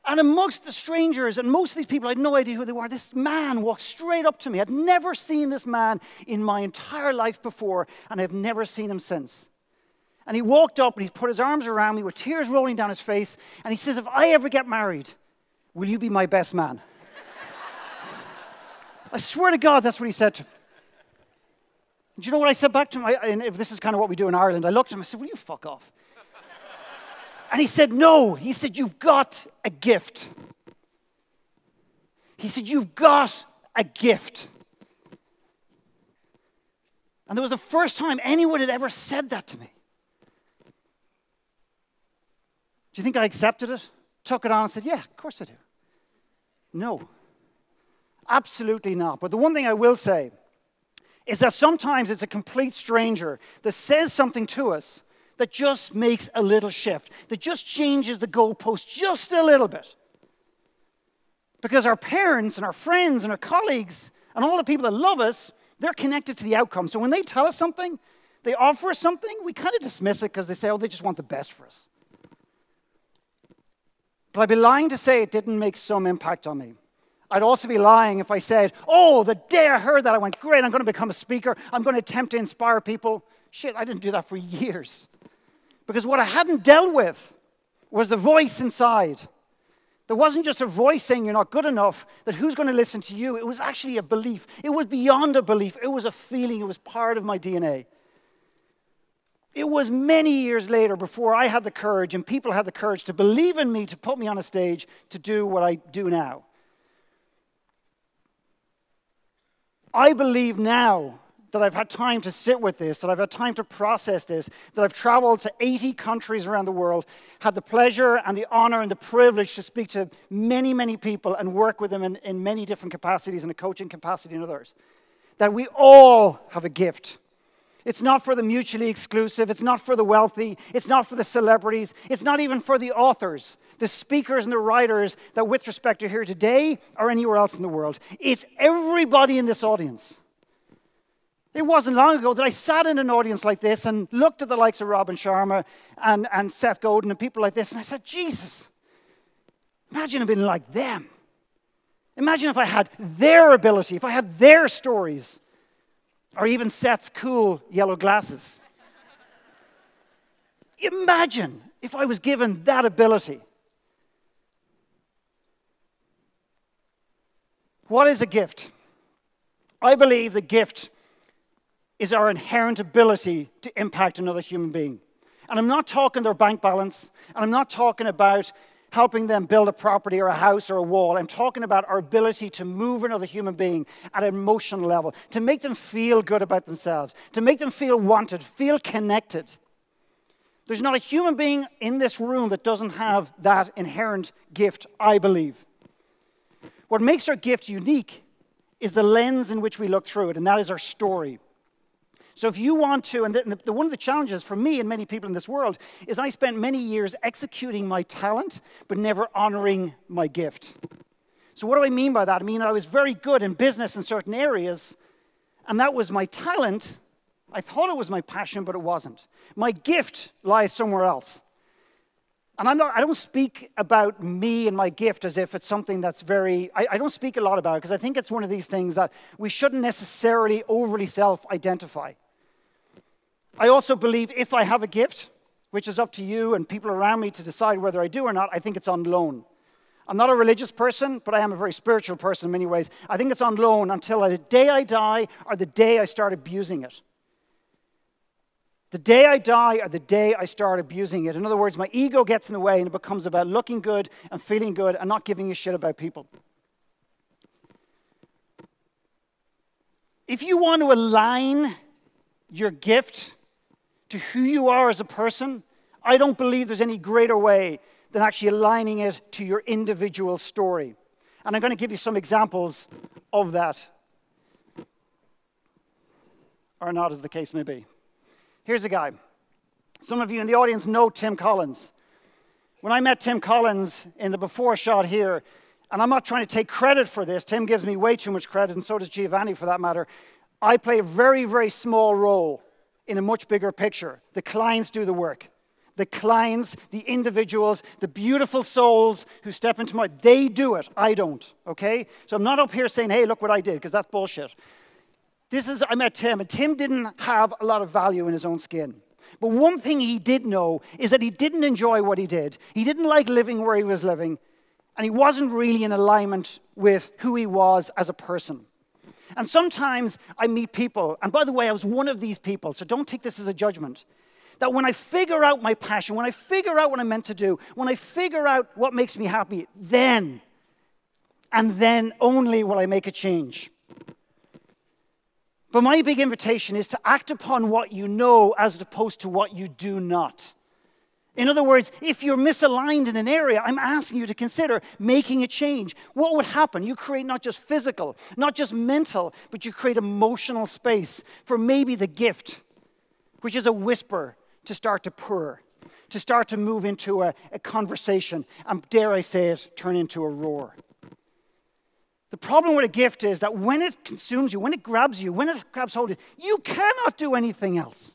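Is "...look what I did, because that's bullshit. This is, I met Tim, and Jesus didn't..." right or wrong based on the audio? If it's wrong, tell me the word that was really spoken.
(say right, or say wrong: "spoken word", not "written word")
wrong: "Tim", not "Jesus".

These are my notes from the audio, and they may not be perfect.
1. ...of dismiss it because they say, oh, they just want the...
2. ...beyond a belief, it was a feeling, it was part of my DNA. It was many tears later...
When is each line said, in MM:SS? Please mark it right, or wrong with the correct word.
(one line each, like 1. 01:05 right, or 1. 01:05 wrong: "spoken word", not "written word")
1. 01:09 right
2. 01:34 wrong: "years", not "tears".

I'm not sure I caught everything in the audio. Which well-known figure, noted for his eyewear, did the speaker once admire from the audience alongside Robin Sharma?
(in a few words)
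Seth Godin.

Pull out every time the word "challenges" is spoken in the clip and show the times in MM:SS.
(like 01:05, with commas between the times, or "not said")
03:23.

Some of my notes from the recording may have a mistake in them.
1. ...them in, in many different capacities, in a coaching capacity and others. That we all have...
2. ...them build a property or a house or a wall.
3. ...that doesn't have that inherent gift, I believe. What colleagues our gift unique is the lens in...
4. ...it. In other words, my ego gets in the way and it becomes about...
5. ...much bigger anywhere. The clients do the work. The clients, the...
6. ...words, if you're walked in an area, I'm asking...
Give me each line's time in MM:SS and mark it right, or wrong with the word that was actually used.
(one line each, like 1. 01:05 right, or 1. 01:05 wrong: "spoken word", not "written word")
1. 02:01 right
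2. 02:59 right
3. 03:12 wrong: "makes", not "colleagues"
4. 04:11 right
5. 04:53 wrong: "picture", not "anywhere"
6. 05:41 wrong: "misaligned", not "walked".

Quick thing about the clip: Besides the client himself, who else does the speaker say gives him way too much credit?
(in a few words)
Giovanni.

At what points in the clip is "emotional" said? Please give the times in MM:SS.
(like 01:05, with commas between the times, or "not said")
03:04, 05:49.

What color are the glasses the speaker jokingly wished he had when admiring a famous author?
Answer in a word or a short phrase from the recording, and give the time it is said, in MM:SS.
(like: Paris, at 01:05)
Yellow, at 02:37.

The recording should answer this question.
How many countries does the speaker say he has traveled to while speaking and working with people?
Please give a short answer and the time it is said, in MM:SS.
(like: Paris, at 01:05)
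80, at 01:55.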